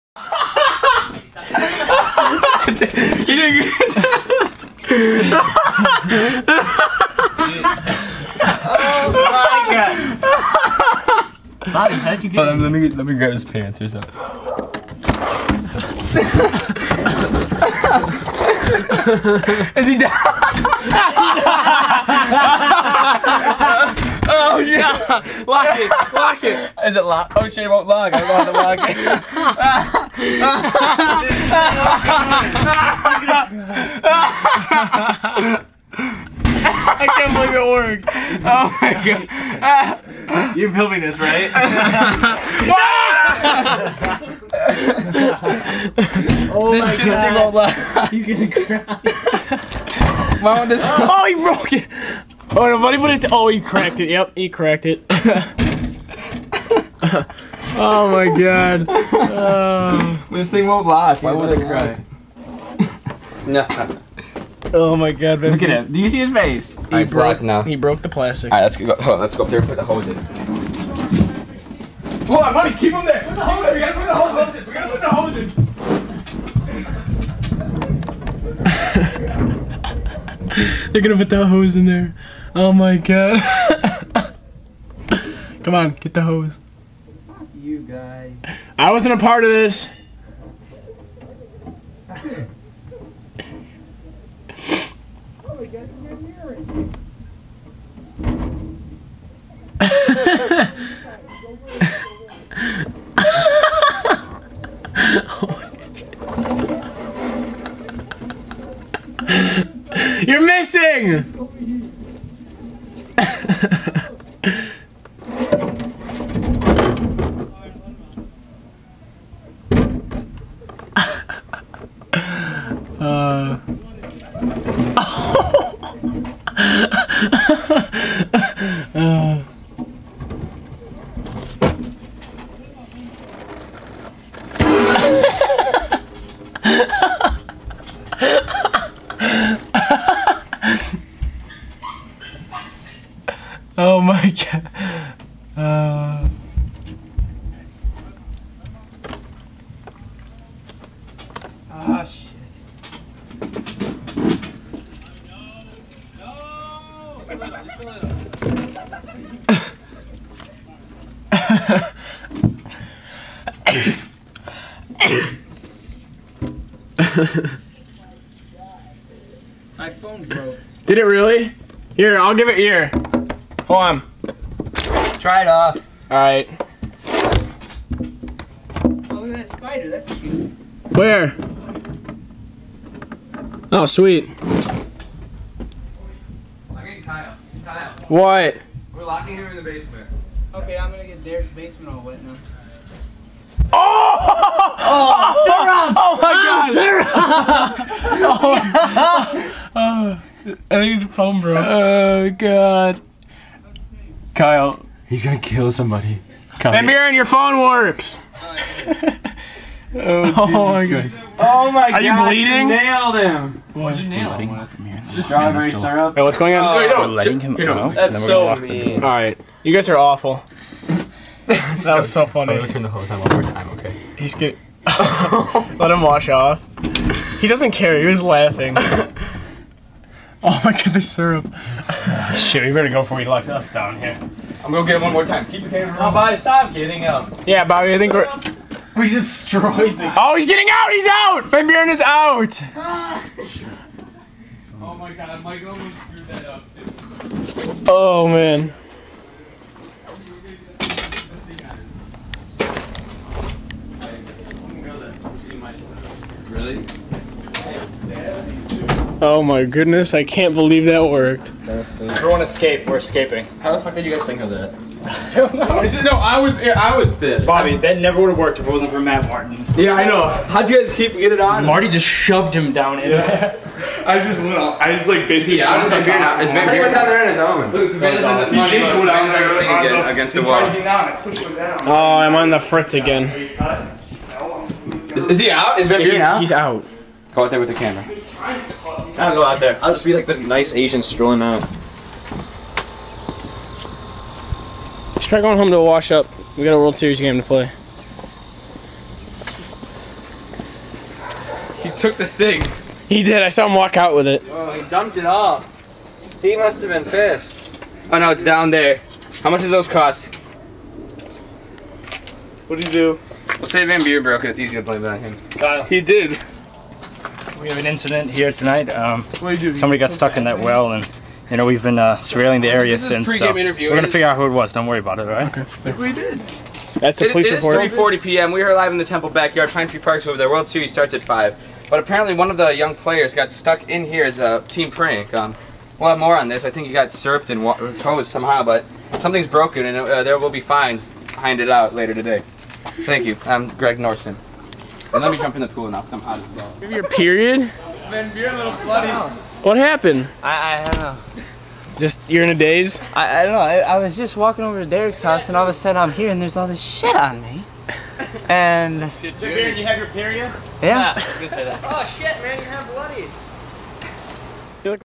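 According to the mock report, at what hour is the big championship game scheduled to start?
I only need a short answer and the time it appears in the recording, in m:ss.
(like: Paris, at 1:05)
5, at 5:31.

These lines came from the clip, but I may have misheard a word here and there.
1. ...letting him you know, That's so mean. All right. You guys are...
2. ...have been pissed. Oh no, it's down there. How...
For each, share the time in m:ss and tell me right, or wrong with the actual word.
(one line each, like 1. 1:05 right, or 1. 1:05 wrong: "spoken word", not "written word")
1. 3:37 right
2. 5:06 right.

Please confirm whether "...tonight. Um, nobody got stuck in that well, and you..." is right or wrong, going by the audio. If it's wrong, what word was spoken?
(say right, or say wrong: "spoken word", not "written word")
wrong: "somebody", not "nobody".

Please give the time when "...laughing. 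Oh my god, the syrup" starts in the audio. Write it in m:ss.
3:48.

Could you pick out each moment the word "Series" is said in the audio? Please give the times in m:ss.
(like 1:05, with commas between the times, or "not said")
4:56, 5:30.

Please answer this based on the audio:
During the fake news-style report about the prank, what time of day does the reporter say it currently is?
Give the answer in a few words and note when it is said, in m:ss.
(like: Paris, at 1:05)
3:40 p.m., at 5:27.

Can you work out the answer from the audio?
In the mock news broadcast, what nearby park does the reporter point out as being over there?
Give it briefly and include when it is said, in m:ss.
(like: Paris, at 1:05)
Pine Tree Park, at 5:29.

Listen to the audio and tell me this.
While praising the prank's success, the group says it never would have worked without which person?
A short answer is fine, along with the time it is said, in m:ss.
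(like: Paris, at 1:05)
Matt Martin, at 4:28.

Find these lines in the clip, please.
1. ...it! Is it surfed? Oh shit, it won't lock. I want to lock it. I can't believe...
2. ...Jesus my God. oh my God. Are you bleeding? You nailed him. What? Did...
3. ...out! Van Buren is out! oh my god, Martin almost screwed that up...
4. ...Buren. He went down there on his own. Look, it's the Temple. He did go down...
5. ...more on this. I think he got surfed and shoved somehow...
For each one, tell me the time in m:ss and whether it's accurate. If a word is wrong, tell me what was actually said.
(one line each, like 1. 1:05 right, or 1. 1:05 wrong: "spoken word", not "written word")
1. 0:26 wrong: "locked", not "surfed"
2. 3:30 right
3. 4:01 wrong: "Michael", not "Martin"
4. 4:36 wrong: "Buren", not "Temple"
5. 5:36 wrong: "hosed", not "shoved".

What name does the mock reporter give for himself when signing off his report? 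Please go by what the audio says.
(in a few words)
Greg Norton.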